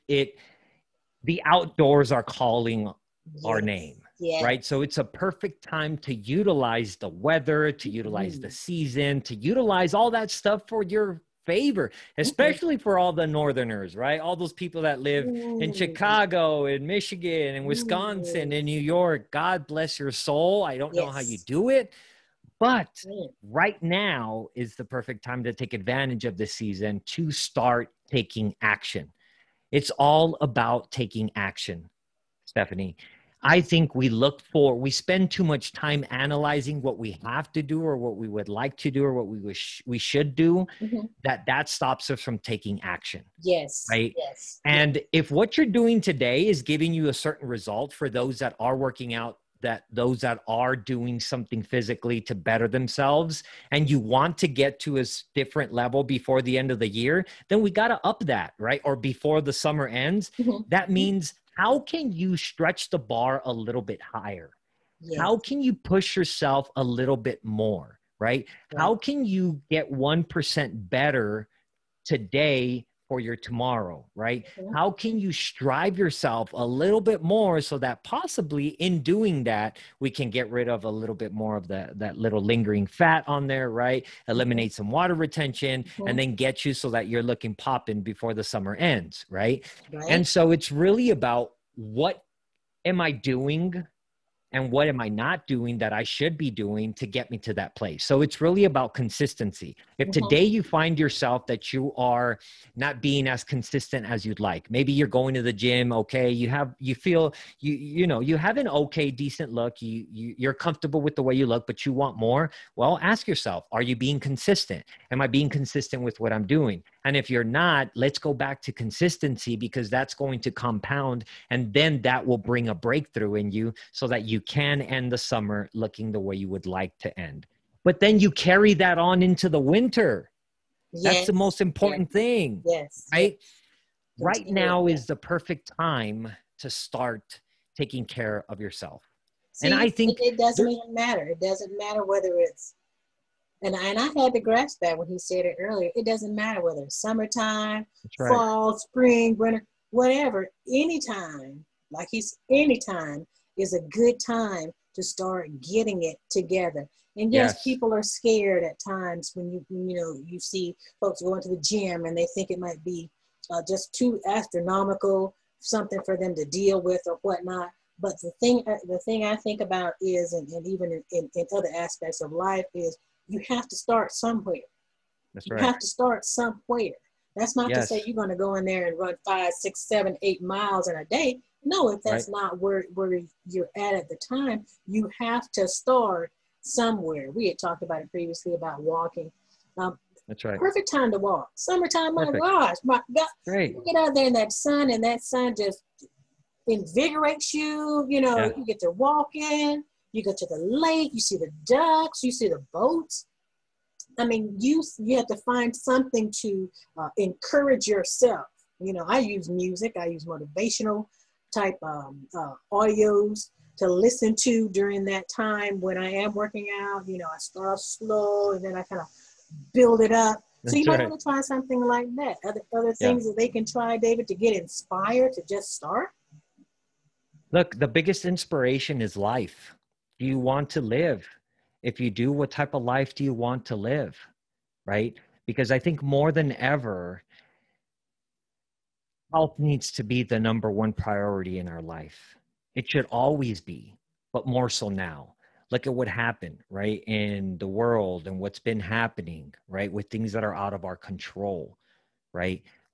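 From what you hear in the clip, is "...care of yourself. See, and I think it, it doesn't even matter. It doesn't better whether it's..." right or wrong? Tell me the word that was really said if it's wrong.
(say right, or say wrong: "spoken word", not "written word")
wrong: "matter", not "better".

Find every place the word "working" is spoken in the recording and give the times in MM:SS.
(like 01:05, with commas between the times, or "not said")
00:48, 03:36.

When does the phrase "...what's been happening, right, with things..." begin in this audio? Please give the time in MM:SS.
04:08.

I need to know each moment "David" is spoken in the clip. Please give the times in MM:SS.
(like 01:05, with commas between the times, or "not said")
03:43.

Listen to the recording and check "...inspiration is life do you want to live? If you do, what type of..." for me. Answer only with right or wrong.
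right.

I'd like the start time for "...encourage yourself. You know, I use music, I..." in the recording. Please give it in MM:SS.
03:27.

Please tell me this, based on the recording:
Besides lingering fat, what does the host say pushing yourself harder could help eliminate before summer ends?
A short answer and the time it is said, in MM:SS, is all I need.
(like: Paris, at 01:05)
water retention, at 01:24.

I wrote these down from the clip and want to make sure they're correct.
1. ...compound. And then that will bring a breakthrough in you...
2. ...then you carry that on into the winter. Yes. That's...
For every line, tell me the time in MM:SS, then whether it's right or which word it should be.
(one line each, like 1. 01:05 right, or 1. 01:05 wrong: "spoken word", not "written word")
1. 02:00 right
2. 02:07 right.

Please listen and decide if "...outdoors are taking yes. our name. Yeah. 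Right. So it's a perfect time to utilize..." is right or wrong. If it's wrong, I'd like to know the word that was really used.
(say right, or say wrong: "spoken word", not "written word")
wrong: "calling", not "taking".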